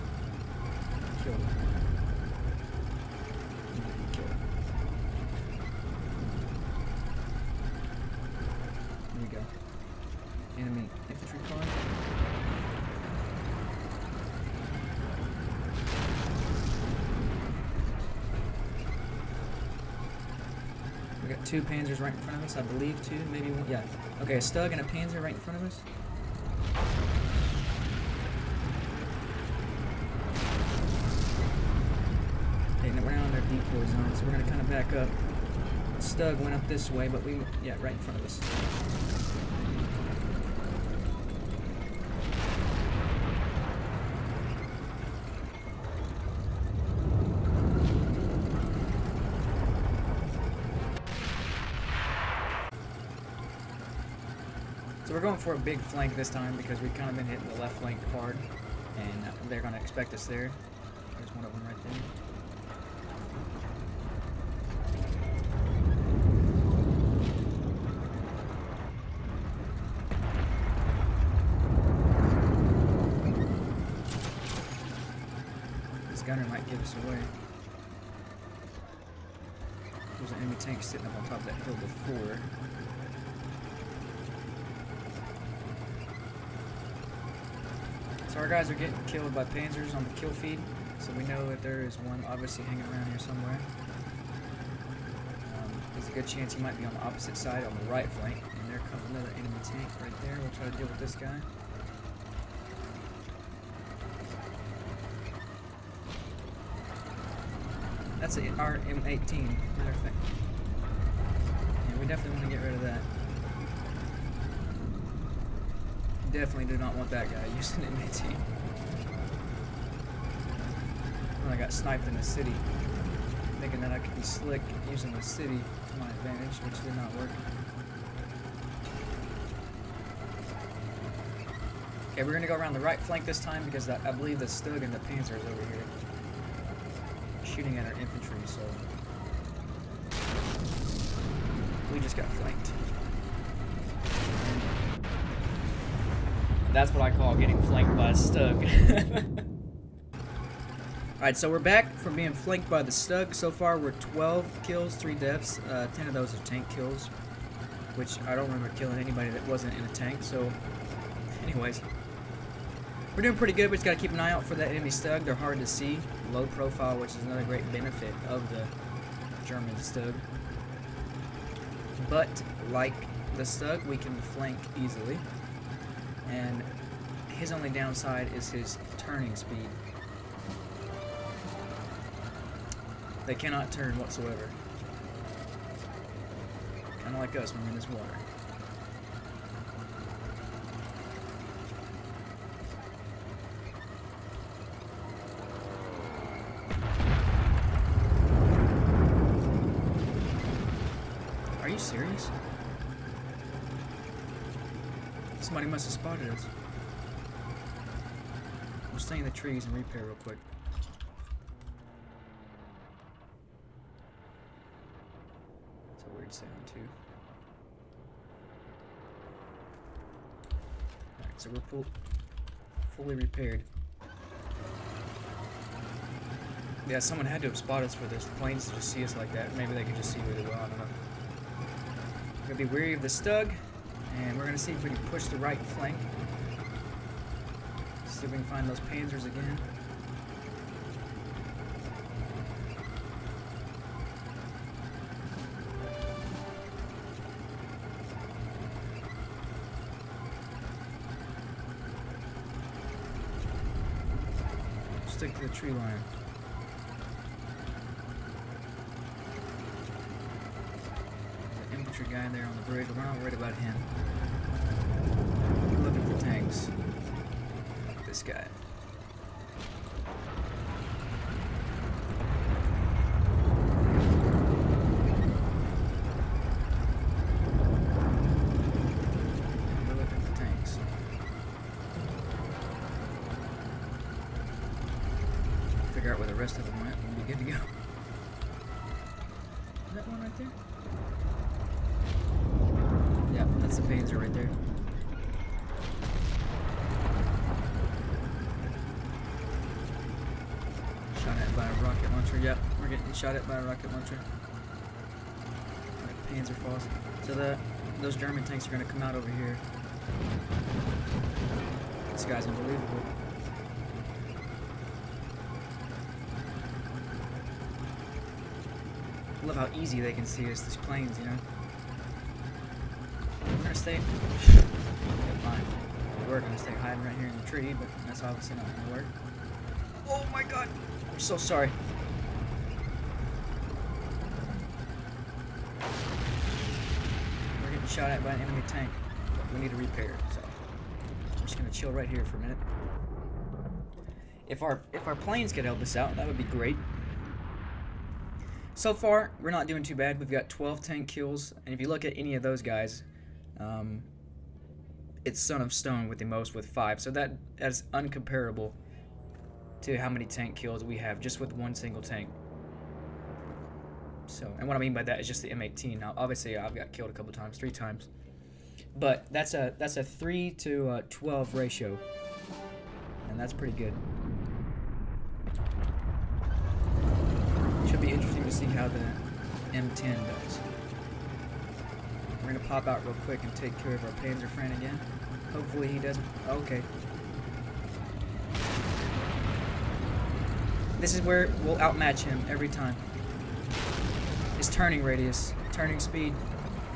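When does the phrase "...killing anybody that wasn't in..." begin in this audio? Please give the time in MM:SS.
02:38.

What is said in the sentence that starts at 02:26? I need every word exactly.
that's what I call getting flanked by a stug.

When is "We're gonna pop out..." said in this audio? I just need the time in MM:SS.
06:22.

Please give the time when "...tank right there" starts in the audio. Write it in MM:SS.
01:39.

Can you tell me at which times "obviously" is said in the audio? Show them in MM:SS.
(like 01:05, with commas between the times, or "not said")
01:32, 05:28, 06:06.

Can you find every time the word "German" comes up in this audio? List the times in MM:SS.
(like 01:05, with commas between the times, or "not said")
02:49, 05:08.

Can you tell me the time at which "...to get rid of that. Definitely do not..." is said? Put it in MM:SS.
01:52.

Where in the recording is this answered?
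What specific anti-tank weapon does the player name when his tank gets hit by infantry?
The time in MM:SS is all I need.
05:06.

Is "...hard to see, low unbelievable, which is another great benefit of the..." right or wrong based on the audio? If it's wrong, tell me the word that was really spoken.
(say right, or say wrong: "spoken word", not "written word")
wrong: "profile", not "unbelievable".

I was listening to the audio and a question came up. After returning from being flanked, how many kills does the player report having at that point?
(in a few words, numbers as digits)
12.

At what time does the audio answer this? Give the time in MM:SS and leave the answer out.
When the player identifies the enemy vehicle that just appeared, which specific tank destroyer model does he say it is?
01:48.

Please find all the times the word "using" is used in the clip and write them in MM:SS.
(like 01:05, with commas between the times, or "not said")
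01:57, 02:04.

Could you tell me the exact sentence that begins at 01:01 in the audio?
There's one of them right there.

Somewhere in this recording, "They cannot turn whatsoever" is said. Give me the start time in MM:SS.
03:03.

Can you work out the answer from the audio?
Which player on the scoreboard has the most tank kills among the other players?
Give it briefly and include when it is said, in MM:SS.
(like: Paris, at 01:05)
Son of Stone, at 05:55.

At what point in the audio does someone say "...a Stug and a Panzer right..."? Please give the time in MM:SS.
00:24.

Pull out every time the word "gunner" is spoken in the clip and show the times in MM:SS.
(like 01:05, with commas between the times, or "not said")
01:16.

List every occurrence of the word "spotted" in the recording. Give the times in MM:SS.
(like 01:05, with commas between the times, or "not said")
03:25, 03:47.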